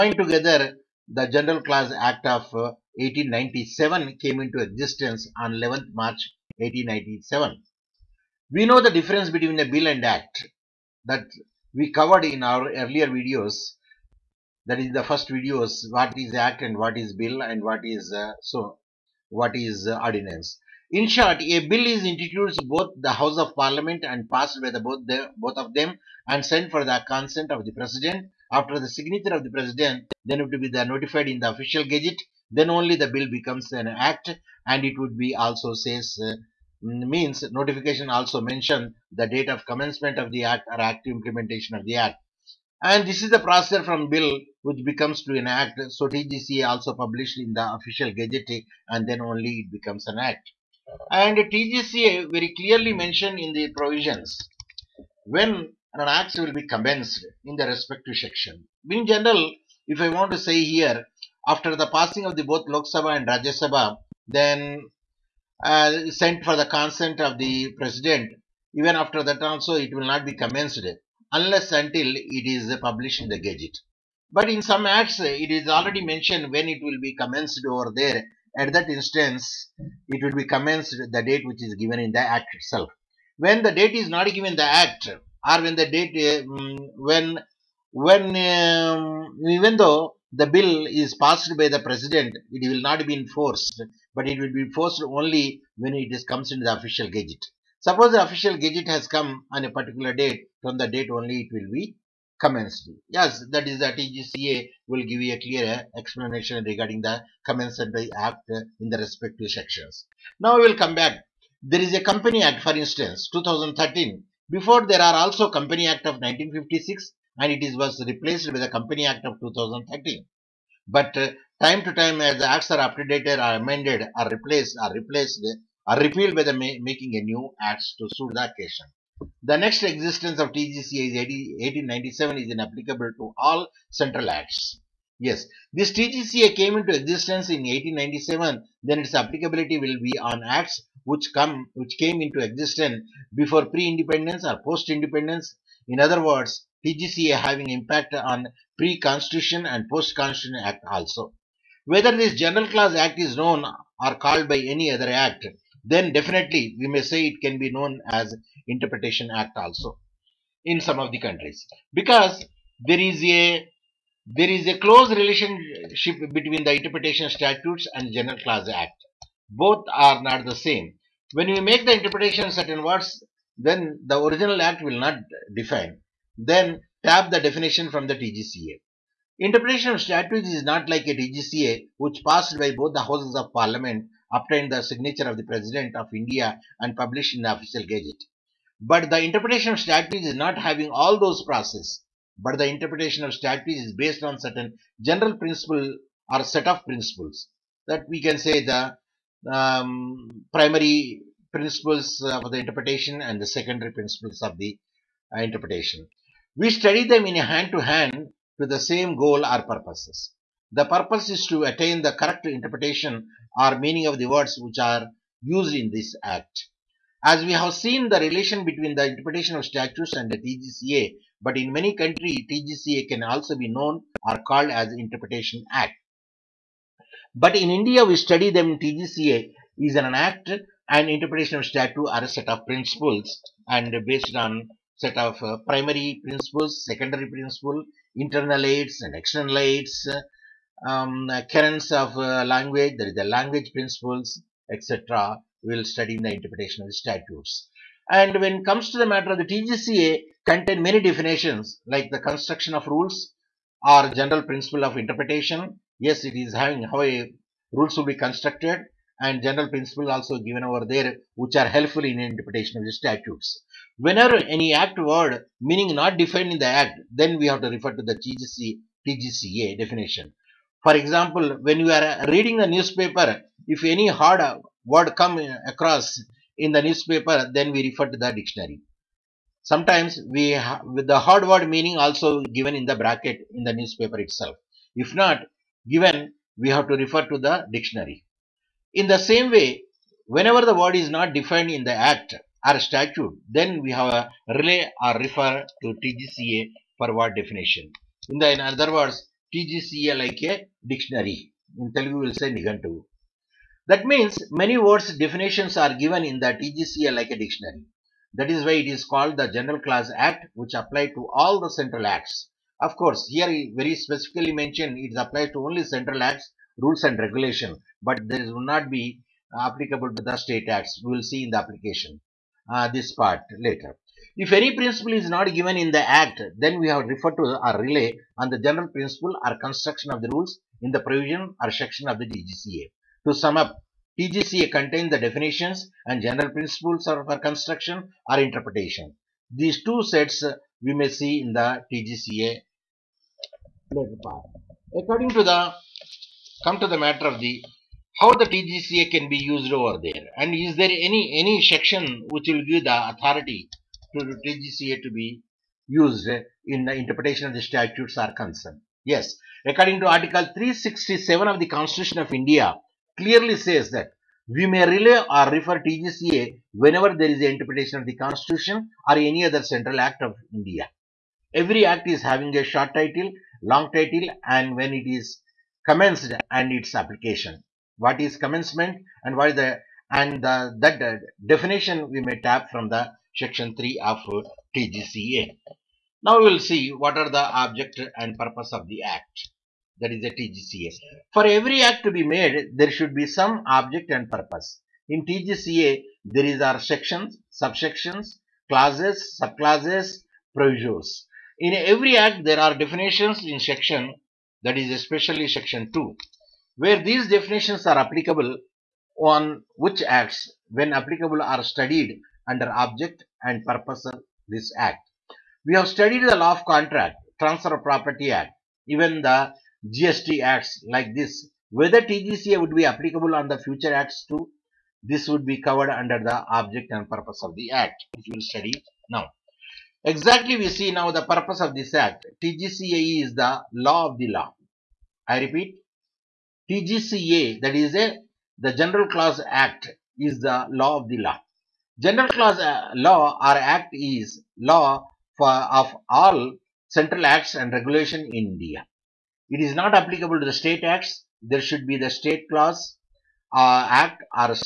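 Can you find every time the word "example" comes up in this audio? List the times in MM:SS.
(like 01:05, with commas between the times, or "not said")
04:30.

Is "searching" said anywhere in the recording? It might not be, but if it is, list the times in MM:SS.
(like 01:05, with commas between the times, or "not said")
not said.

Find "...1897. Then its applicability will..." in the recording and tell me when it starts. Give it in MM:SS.
02:17.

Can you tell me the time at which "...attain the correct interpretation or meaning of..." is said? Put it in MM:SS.
03:31.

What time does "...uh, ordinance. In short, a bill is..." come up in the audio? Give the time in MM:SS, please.
00:19.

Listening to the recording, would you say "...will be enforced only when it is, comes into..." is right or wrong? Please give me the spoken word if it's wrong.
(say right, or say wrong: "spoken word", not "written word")
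right.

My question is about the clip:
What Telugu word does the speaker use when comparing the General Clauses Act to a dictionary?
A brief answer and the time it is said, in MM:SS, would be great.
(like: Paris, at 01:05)
Nigantu, at 05:02.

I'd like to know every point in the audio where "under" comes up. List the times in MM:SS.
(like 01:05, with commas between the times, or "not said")
06:52, 07:05.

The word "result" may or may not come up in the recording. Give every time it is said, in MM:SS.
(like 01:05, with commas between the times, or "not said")
not said.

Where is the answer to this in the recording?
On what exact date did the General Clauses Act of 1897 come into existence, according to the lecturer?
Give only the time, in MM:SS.
00:05.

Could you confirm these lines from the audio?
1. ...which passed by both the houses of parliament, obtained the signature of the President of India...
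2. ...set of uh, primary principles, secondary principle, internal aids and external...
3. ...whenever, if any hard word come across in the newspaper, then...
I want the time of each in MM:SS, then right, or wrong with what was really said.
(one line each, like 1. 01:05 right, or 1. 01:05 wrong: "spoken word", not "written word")
1. 03:01 right
2. 03:54 right
3. 04:32 wrong: "newspaper", not "whenever".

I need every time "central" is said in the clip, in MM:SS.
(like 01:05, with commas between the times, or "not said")
02:13, 05:11, 05:15, 06:09, 07:26.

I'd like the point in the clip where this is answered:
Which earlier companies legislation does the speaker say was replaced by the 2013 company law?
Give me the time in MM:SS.
01:55.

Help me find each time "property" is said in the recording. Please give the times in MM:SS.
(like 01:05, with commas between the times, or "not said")
06:57.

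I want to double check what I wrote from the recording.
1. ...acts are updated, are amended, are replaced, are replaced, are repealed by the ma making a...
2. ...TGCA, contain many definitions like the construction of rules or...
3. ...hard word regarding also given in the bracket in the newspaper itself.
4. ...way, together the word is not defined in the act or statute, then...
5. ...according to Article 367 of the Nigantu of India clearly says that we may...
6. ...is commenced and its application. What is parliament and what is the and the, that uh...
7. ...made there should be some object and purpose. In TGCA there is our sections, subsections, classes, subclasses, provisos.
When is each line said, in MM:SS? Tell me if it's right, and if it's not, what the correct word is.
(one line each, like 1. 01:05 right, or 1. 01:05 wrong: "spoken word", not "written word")
1. 02:02 right
2. 04:09 right
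3. 04:41 wrong: "meaning", not "regarding"
4. 04:49 wrong: "whenever", not "together"
5. 05:59 wrong: "Constitution", not "Nigantu"
6. 06:15 wrong: "commencement", not "parliament"
7. 06:32 right.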